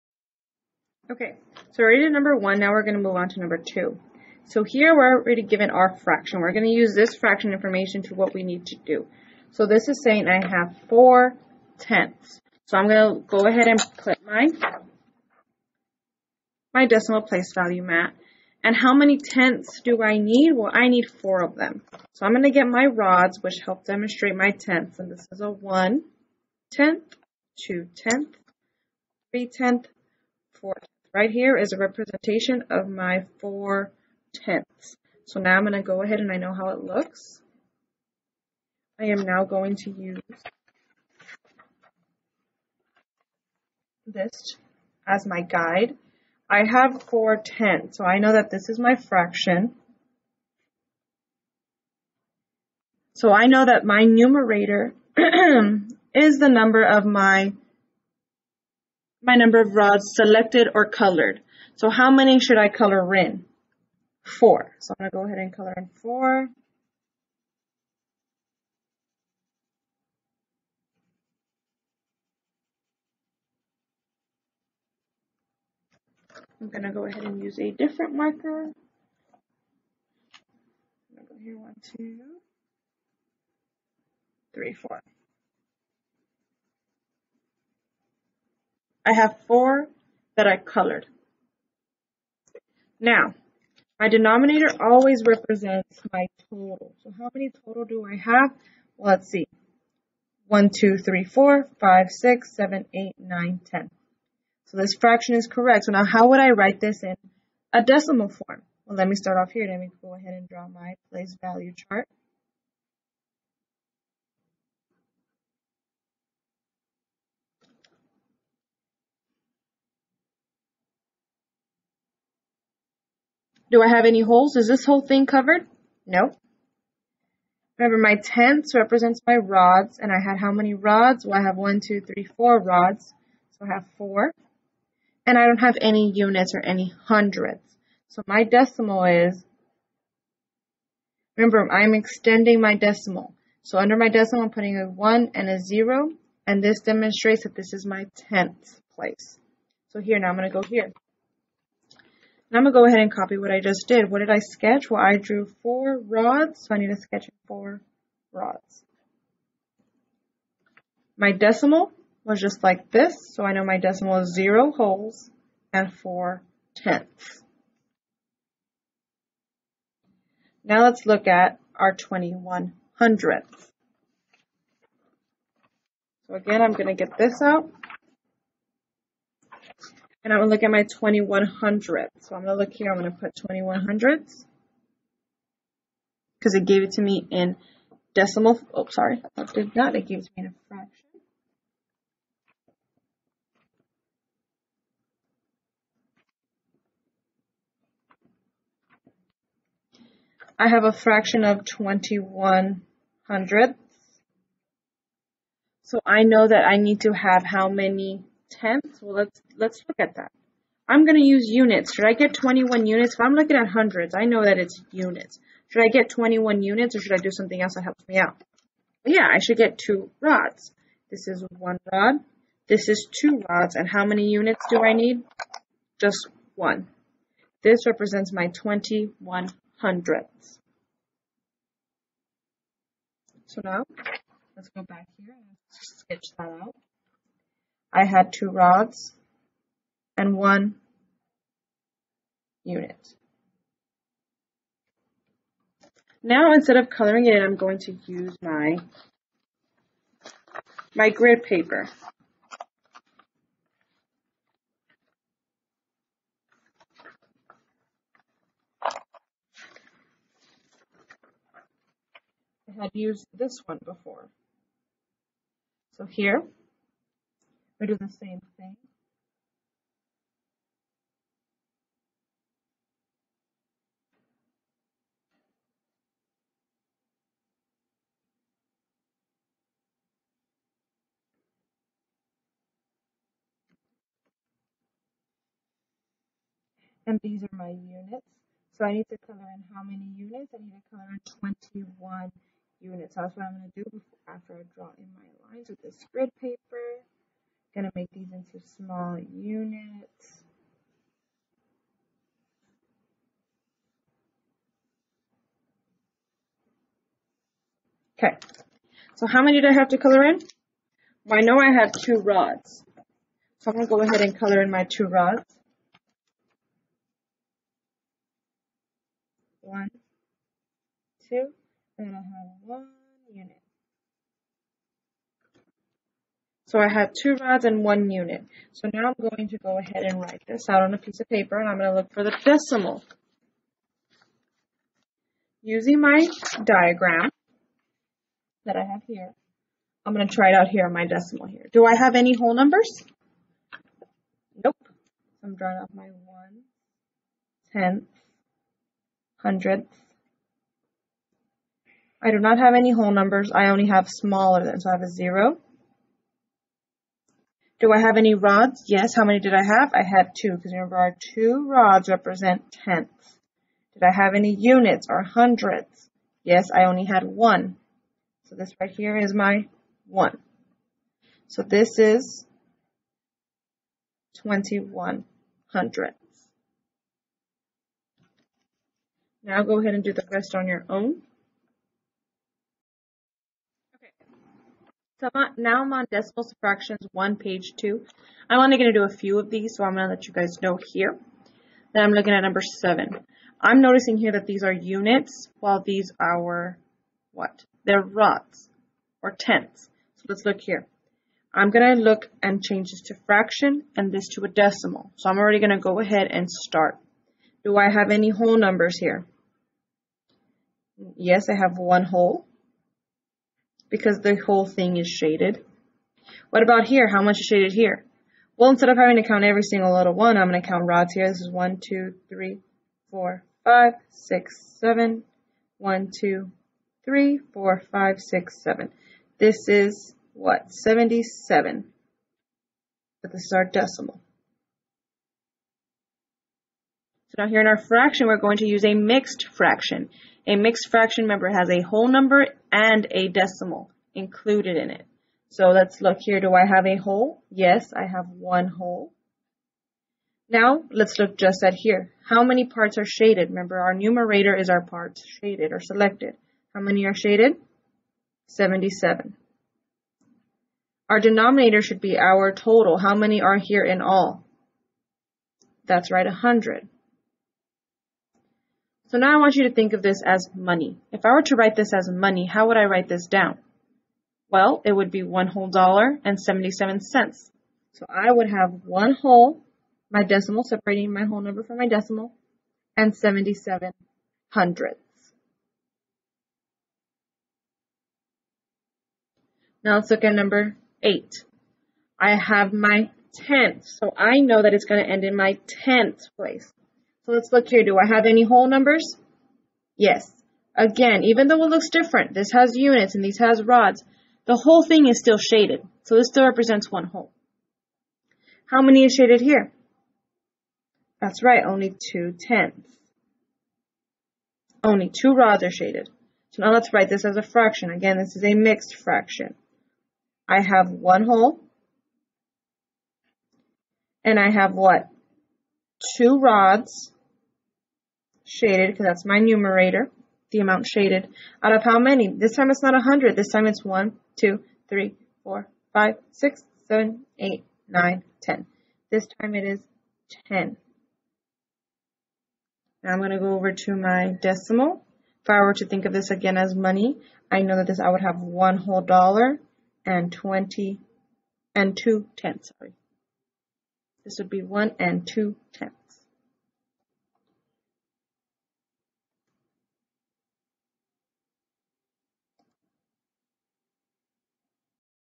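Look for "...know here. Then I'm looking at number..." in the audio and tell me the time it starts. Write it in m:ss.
6:30.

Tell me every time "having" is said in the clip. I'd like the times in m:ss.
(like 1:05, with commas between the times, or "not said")
6:58.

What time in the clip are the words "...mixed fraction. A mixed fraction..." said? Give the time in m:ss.
7:18.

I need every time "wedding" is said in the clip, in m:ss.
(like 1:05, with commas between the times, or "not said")
not said.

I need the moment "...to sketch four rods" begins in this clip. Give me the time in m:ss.
2:36.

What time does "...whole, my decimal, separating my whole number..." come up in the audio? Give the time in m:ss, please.
7:59.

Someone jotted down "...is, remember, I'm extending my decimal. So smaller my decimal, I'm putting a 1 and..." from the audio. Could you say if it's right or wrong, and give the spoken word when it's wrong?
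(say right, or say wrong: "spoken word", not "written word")
wrong: "under", not "smaller".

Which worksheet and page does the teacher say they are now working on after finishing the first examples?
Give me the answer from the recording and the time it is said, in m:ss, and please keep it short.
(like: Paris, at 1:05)
decimals, fractions 1, page 2, at 6:26.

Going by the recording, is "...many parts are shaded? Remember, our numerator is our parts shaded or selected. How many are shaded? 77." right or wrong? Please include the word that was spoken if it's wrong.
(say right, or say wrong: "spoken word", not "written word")
right.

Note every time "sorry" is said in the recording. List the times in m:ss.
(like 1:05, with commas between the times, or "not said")
3:08, 9:12.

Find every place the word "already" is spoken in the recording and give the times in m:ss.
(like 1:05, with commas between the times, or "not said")
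0:05, 6:45.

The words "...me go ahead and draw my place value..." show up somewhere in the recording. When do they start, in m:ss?
1:49.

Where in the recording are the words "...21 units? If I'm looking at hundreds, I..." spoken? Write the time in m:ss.
3:32.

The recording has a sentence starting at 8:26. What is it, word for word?
So this still represents one whole.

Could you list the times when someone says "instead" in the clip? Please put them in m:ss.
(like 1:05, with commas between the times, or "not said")
4:06, 6:58.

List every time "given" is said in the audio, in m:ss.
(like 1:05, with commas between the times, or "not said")
0:05.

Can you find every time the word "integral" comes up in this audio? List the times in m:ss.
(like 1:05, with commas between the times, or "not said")
not said.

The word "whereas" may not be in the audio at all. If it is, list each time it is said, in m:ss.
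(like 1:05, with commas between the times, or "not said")
not said.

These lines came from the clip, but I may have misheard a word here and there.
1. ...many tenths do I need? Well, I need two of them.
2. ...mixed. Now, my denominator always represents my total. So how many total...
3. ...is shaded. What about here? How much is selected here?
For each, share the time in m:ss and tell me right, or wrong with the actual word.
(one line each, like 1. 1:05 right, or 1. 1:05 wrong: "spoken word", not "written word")
1. 0:18 wrong: "four", not "two"
2. 1:30 wrong: "colored", not "mixed"
3. 6:54 wrong: "shaded", not "selected".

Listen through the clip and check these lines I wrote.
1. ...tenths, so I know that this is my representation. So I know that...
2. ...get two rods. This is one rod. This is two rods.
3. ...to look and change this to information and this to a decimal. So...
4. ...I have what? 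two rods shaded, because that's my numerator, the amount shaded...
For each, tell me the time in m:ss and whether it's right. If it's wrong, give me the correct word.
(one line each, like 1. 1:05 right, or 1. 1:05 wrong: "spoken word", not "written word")
1. 0:47 wrong: "fraction", not "representation"
2. 3:39 right
3. 6:41 wrong: "fraction", not "information"
4. 8:44 right.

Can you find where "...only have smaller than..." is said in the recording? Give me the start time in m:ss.
5:53.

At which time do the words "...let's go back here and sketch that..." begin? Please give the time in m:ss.
3:54.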